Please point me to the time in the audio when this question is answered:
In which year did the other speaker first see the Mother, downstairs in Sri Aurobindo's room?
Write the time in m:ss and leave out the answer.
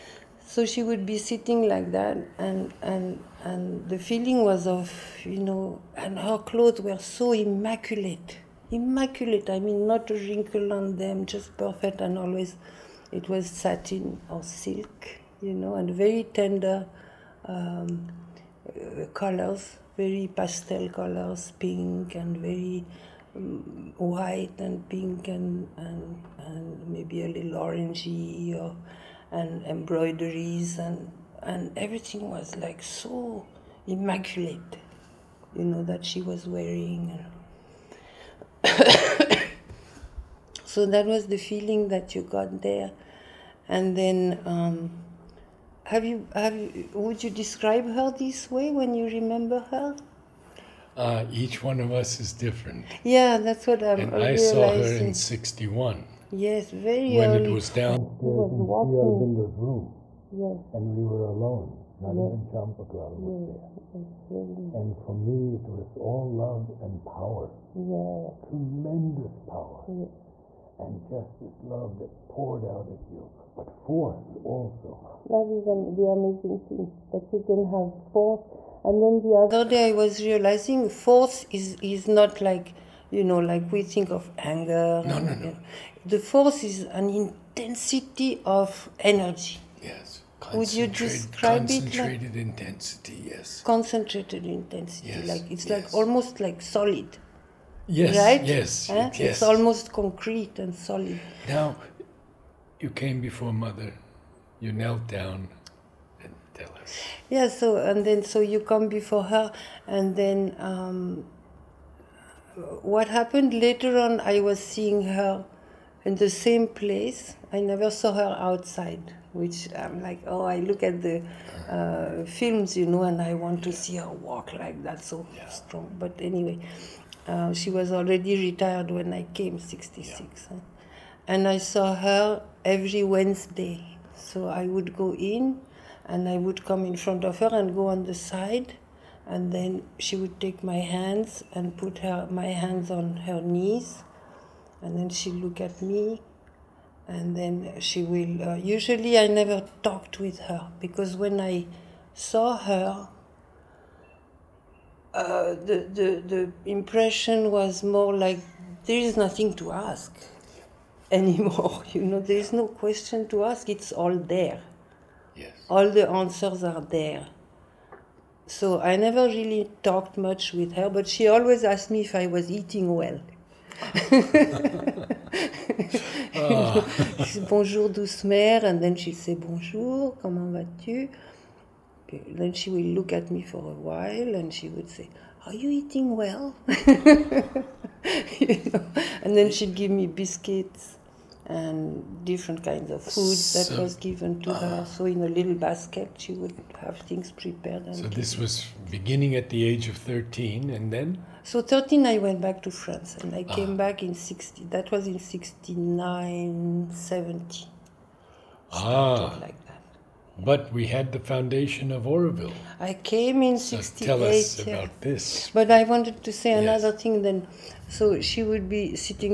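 0:55.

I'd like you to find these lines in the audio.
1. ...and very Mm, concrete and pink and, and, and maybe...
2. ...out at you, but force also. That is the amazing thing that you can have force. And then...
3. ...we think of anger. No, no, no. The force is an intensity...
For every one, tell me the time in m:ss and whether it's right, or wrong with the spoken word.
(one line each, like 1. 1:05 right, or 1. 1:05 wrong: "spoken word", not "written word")
1. 0:22 wrong: "white", not "concrete"
2. 1:12 right
3. 1:23 right.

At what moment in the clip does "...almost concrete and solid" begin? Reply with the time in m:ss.
1:39.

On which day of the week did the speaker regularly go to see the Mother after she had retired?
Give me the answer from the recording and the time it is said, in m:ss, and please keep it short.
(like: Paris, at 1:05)
Wednesday, at 2:13.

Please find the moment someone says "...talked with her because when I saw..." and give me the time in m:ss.
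2:29.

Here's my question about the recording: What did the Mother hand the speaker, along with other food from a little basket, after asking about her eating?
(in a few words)
Biscuits.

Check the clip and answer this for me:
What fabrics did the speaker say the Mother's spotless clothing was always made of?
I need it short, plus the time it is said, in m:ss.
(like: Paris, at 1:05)
Satin or silk, at 0:13.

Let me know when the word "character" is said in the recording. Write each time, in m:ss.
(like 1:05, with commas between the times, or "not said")
not said.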